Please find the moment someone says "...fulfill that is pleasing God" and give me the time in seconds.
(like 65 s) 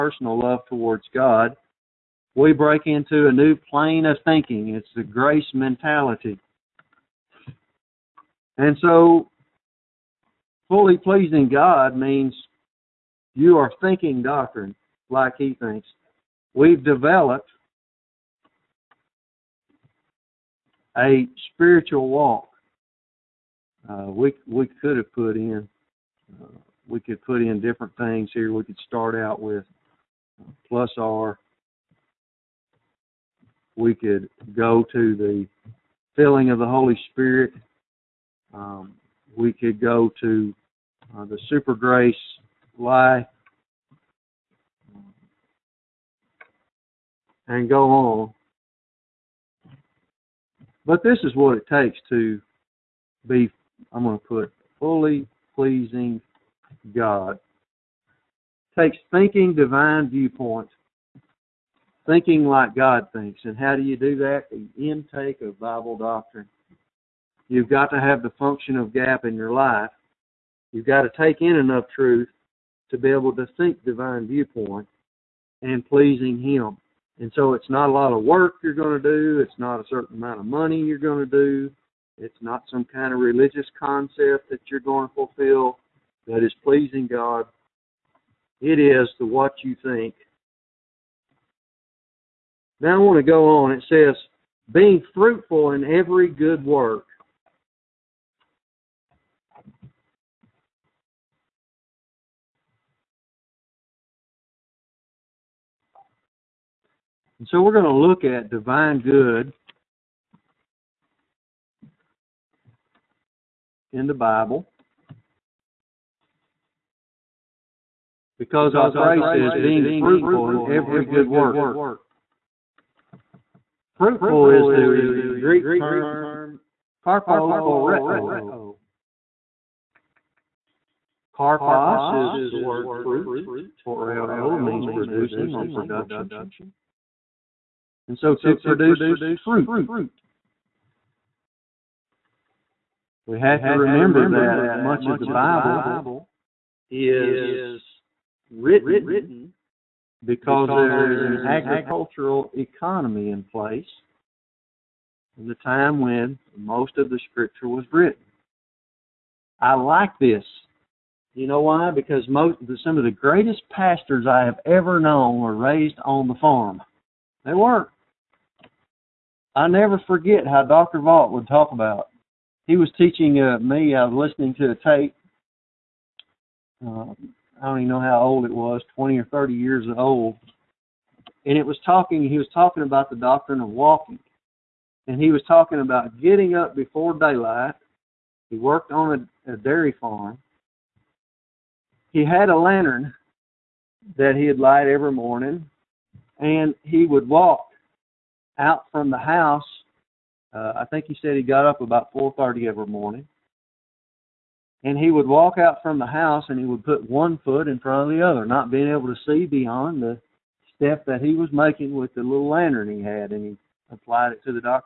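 85 s.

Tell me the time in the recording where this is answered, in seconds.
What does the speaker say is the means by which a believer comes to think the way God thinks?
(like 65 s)
64 s.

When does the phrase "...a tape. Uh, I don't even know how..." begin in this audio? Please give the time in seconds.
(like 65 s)
174 s.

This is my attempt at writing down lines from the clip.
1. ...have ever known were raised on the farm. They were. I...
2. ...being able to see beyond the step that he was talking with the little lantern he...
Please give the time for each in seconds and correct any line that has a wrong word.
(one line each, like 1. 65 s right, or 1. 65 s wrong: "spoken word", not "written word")
1. 164 s right
2. 208 s wrong: "making", not "talking".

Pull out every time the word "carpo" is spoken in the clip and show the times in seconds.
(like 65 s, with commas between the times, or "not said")
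127 s, 131 s.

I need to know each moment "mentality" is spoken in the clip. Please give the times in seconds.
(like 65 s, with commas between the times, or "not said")
5 s.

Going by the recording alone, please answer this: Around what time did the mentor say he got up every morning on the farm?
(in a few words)
4:30.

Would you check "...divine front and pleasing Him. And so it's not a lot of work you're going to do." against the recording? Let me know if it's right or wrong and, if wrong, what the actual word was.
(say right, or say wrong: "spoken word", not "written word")
wrong: "viewpoint", not "front".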